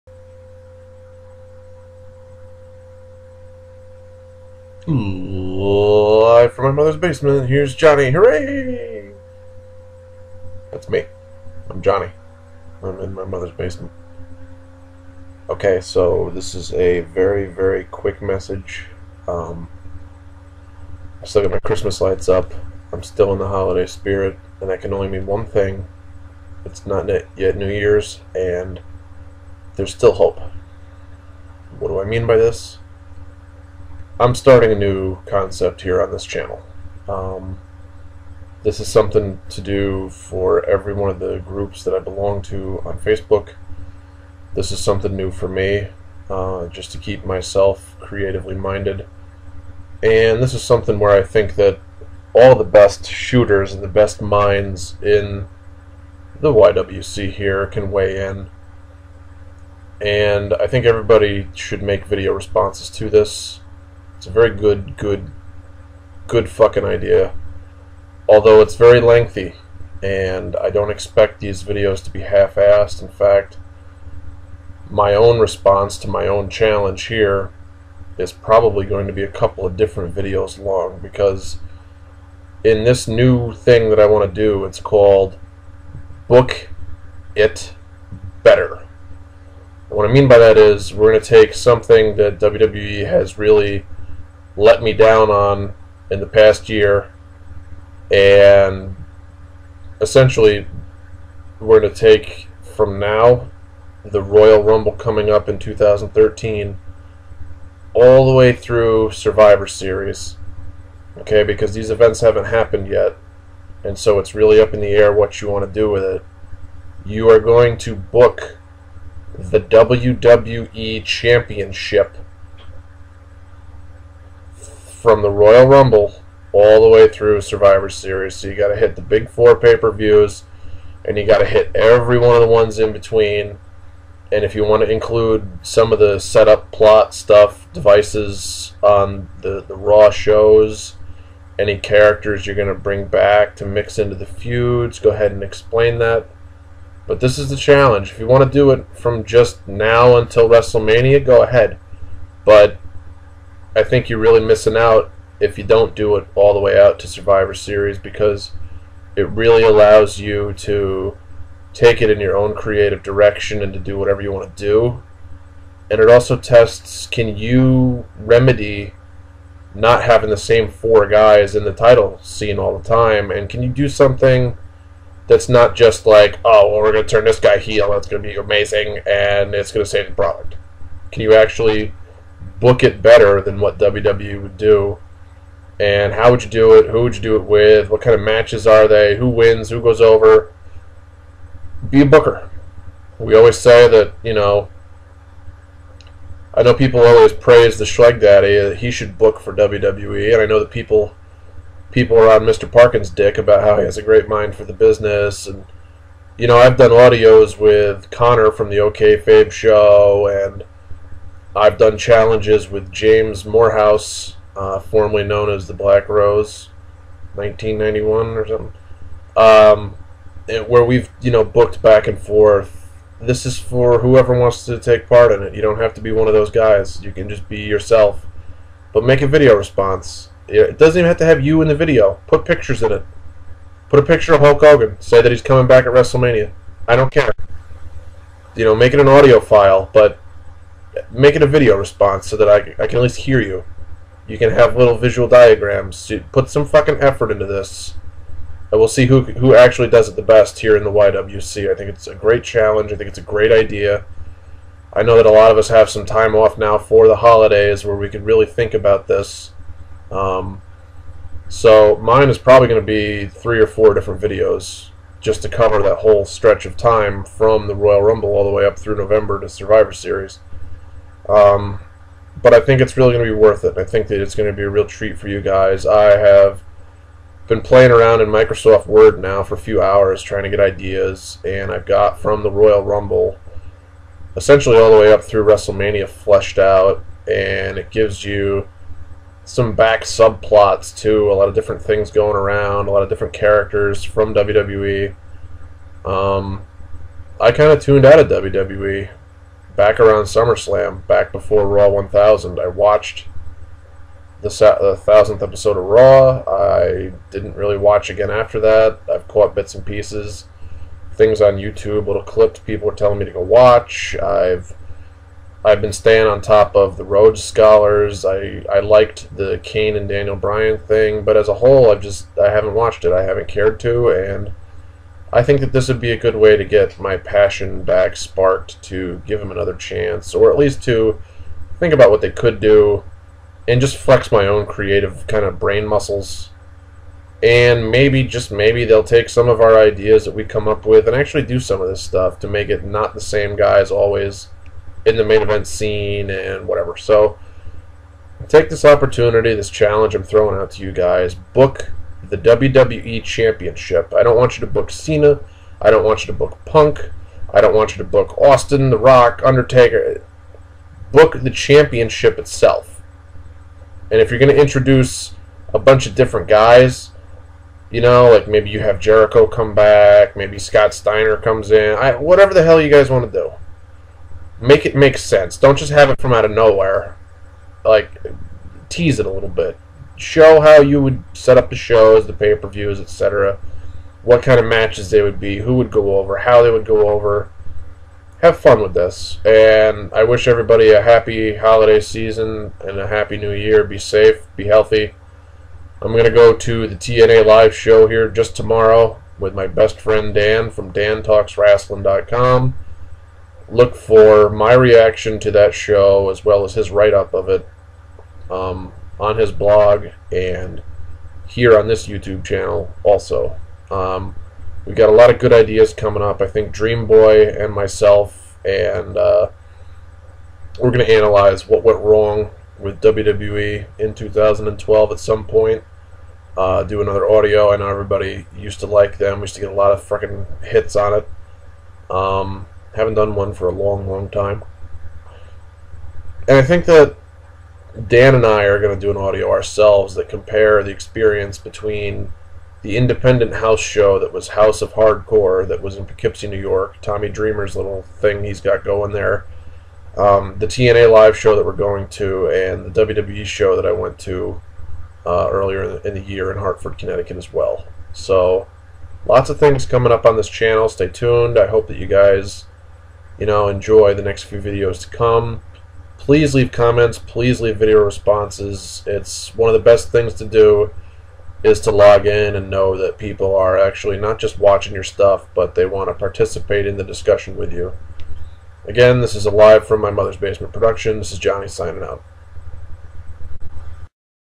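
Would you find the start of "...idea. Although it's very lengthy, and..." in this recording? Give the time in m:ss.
1:06.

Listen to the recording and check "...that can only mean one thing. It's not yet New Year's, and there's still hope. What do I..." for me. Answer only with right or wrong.
right.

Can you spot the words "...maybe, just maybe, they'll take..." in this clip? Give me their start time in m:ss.
5:37.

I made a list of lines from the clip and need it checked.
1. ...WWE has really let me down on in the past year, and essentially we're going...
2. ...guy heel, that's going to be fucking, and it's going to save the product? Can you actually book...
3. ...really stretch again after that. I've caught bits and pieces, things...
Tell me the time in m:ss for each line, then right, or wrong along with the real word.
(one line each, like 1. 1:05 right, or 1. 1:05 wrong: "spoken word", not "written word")
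1. 1:32 right
2. 2:57 wrong: "amazing", not "fucking"
3. 5:07 wrong: "watch", not "stretch".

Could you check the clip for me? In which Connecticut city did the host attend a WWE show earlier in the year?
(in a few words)
Hartford.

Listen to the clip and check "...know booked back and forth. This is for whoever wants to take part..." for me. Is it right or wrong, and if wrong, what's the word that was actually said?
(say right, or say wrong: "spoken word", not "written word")
right.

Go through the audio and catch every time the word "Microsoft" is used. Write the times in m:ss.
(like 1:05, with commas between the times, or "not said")
4:38.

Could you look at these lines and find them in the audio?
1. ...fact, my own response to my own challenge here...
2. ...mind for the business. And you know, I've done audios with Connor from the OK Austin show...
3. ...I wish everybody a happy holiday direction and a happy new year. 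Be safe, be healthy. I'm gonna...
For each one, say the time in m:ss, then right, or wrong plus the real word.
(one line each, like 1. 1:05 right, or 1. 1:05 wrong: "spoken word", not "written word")
1. 1:13 right
2. 3:24 wrong: "Fabe", not "Austin"
3. 6:30 wrong: "season", not "direction".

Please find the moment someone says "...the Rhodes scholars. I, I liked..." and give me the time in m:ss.
5:16.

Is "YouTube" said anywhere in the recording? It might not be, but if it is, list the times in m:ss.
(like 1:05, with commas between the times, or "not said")
5:11, 6:52.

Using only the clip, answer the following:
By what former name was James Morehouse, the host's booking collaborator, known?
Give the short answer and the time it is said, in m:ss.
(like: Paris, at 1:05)
the Black Rose, at 3:35.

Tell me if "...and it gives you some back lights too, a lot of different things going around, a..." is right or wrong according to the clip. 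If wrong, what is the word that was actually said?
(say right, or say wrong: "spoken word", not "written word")
wrong: "subplots", not "lights".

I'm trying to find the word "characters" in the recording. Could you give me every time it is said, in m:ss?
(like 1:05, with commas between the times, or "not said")
2:21, 4:53.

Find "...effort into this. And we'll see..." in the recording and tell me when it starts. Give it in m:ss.
4:07.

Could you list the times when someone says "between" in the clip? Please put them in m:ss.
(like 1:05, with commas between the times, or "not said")
2:12, 7:21.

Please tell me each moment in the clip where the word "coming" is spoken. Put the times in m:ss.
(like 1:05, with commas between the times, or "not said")
1:44, 3:55, 6:55, 7:39.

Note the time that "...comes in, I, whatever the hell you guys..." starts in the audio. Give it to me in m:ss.
6:11.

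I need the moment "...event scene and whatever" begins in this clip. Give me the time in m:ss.
5:45.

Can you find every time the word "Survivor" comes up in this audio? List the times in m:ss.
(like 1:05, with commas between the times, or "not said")
1:49, 2:07, 2:37, 4:29.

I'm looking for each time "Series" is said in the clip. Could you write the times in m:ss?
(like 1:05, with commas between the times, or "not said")
1:49, 2:07, 2:37, 4:29.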